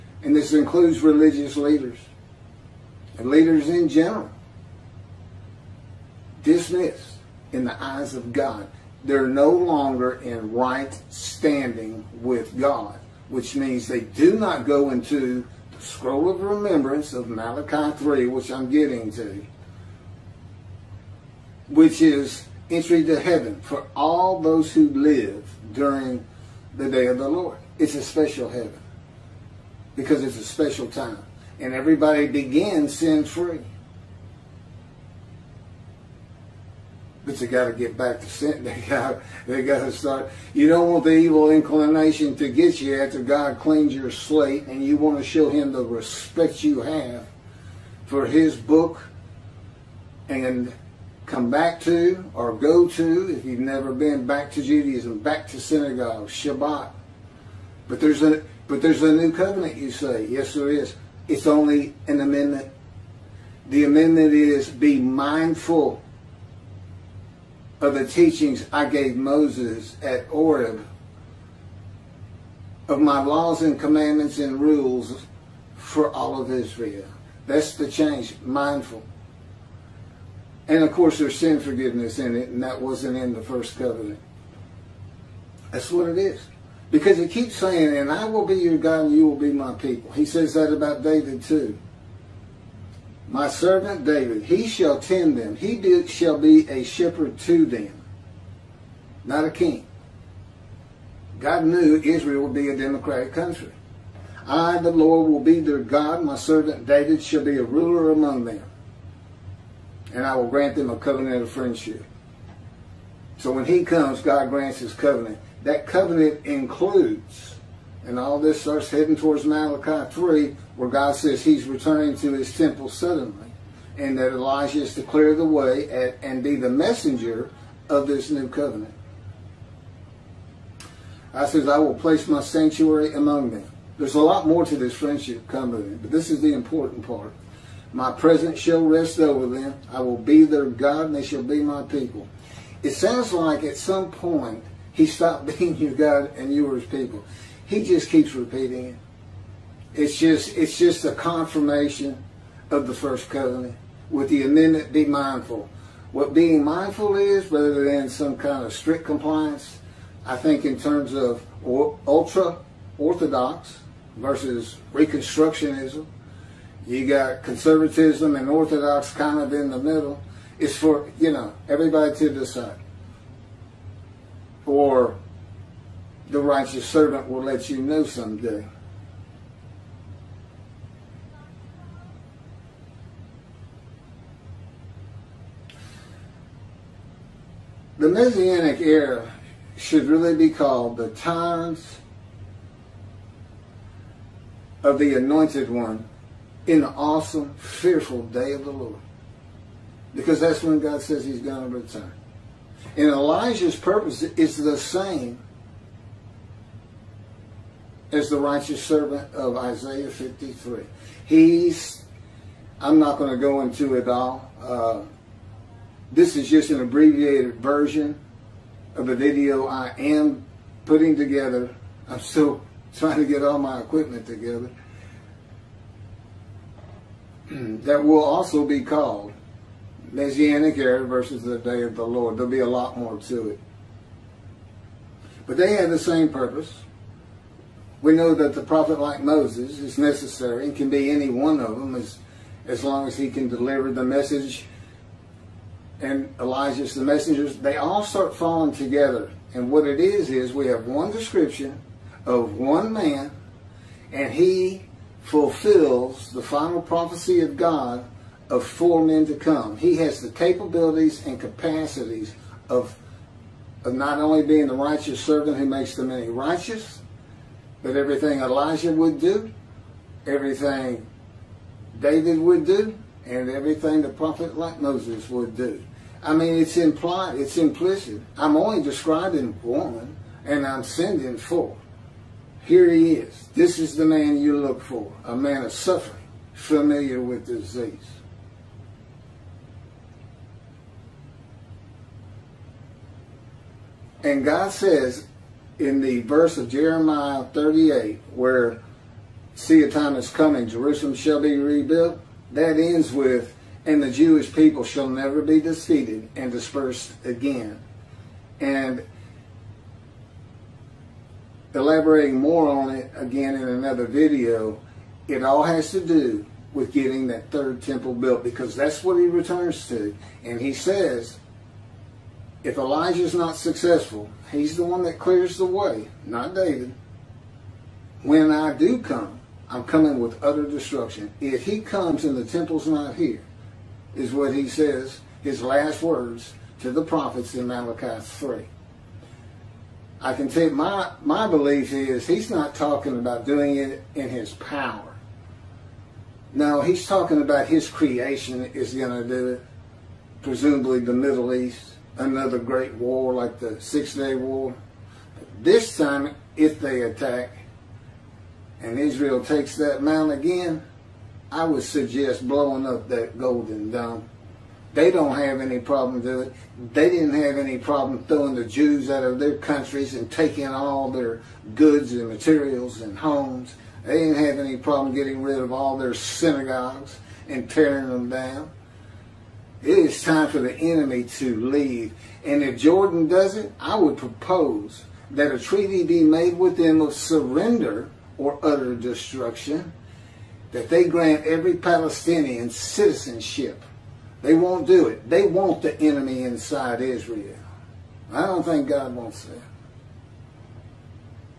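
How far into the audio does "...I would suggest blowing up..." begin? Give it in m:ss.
6:01.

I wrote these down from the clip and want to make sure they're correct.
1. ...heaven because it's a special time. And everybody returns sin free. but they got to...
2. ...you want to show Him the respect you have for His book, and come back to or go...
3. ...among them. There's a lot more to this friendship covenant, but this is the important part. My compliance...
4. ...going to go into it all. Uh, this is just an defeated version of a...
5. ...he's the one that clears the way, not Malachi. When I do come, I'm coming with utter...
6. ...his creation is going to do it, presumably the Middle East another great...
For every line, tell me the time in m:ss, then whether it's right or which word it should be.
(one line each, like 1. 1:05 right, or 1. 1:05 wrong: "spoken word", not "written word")
1. 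0:28 wrong: "begins", not "returns"
2. 0:44 right
3. 2:13 wrong: "presence", not "compliance"
4. 3:33 wrong: "abbreviated", not "defeated"
5. 5:24 wrong: "David", not "Malachi"
6. 5:47 right.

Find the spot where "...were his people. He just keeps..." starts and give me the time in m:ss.
2:26.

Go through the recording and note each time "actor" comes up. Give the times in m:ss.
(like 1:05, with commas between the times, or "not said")
not said.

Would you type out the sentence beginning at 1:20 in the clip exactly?
And of course, there's sin forgiveness in it, and that wasn't in the first covenant.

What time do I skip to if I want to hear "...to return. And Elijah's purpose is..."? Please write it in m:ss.
3:21.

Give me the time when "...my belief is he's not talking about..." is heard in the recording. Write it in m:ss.
5:41.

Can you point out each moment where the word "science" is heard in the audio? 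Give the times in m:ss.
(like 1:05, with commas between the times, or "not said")
not said.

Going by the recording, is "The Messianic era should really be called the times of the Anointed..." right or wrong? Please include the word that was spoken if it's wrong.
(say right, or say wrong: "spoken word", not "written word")
right.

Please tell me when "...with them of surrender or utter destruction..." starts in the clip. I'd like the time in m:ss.
6:26.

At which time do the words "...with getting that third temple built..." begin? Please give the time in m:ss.
5:16.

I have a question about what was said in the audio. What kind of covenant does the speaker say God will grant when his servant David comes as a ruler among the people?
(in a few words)
covenant of friendship.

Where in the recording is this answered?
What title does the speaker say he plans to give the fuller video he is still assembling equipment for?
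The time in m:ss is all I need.
3:50.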